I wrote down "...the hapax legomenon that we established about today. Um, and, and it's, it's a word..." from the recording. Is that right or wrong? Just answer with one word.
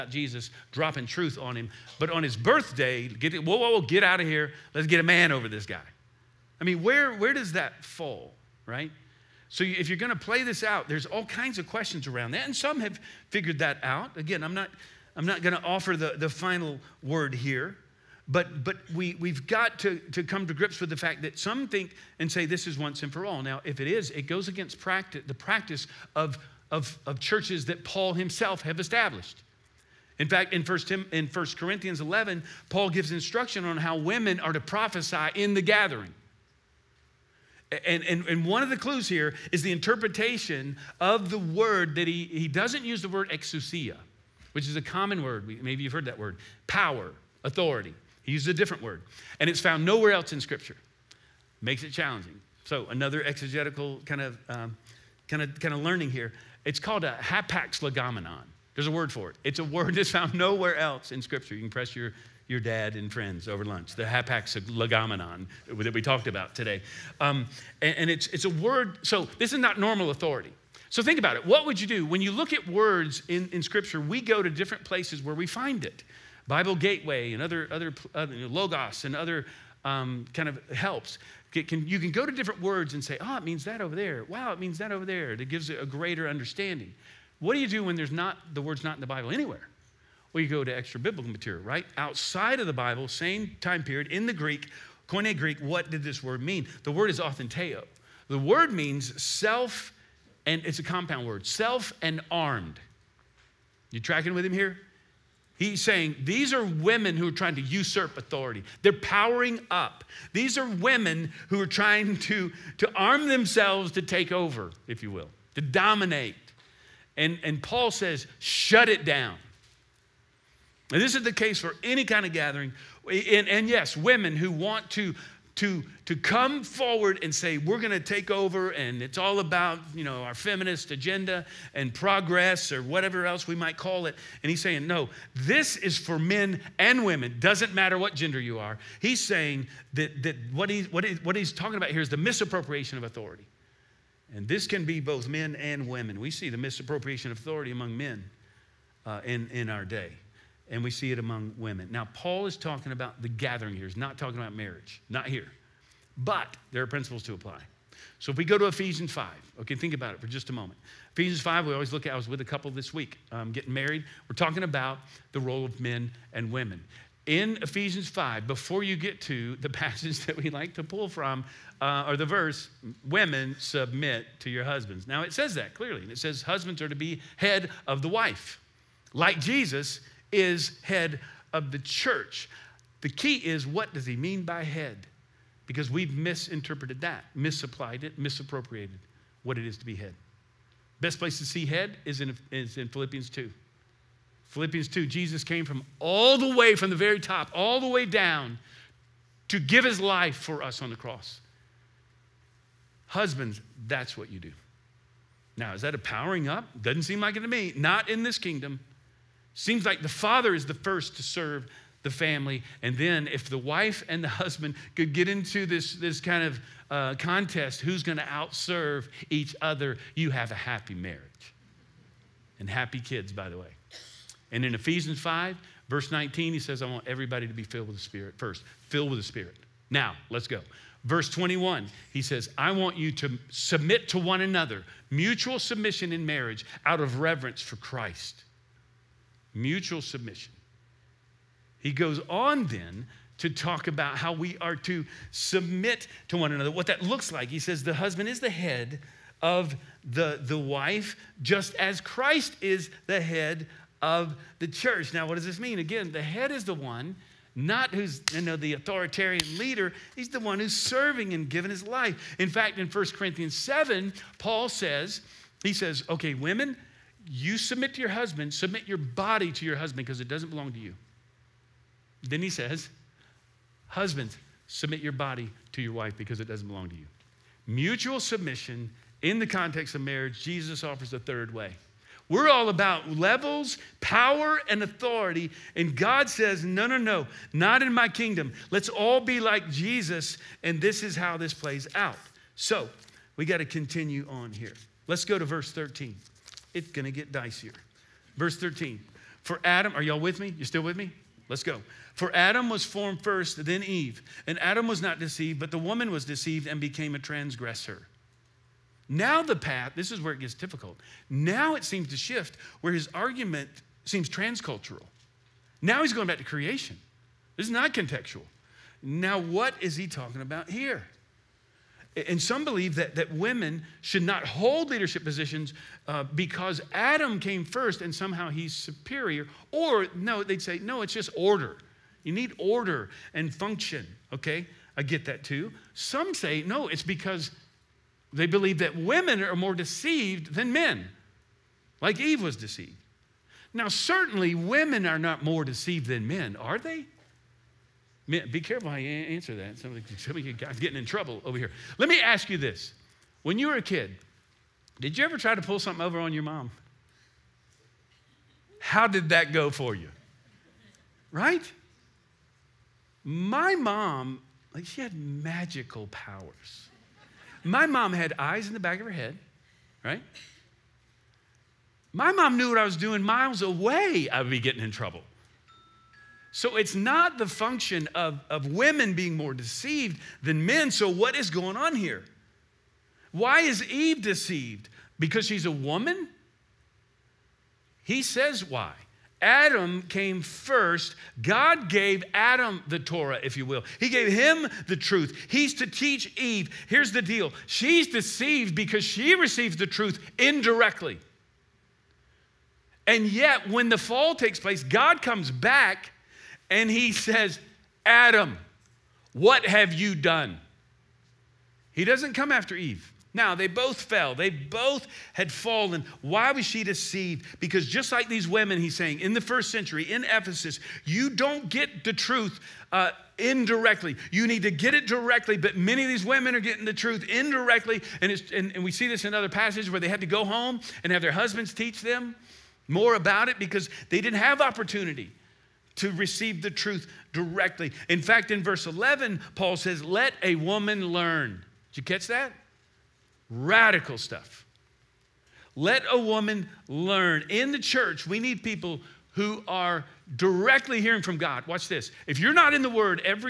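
wrong.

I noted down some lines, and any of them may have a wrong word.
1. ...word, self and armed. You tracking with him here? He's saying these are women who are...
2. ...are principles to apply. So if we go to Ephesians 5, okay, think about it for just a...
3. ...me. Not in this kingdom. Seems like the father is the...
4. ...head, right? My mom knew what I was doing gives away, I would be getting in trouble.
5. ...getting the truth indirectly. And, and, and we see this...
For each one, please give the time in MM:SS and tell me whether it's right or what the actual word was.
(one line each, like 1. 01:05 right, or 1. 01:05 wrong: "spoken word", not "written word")
1. 01:41 right
2. 02:36 right
3. 03:27 right
4. 06:09 wrong: "miles", not "gives"
5. 07:06 right.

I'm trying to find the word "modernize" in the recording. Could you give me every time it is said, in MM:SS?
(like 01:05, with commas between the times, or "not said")
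not said.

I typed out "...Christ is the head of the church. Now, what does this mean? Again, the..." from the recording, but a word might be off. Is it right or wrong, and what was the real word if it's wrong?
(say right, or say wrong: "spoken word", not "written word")
right.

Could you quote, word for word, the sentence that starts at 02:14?
And he's saying, no, this is for men and women.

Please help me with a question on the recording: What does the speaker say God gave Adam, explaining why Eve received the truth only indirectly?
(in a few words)
the Torah.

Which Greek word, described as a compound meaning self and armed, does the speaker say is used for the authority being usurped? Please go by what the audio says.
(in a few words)
authenteo.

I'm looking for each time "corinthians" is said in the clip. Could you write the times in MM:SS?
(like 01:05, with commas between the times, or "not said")
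00:31, 04:23.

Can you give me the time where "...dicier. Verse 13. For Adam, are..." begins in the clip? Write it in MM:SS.
04:57.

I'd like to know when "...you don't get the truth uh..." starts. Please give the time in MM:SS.
07:01.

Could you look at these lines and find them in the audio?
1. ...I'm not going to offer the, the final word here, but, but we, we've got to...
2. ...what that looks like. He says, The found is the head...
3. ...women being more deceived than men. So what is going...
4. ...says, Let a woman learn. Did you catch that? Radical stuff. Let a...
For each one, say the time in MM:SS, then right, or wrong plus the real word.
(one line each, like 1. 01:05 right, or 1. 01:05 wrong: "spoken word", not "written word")
1. 00:15 right
2. 04:06 wrong: "husband", not "found"
3. 06:18 right
4. 07:19 right.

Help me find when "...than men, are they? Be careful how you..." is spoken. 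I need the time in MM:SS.
05:46.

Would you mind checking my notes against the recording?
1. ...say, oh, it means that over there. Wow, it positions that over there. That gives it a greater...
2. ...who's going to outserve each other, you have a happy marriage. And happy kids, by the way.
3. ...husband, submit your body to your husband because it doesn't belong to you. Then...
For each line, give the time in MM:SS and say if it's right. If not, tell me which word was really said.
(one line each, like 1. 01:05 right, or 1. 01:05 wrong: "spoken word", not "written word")
1. 01:23 wrong: "means", not "positions"
2. 03:37 right
3. 04:28 right.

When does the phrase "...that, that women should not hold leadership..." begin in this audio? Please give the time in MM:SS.
05:22.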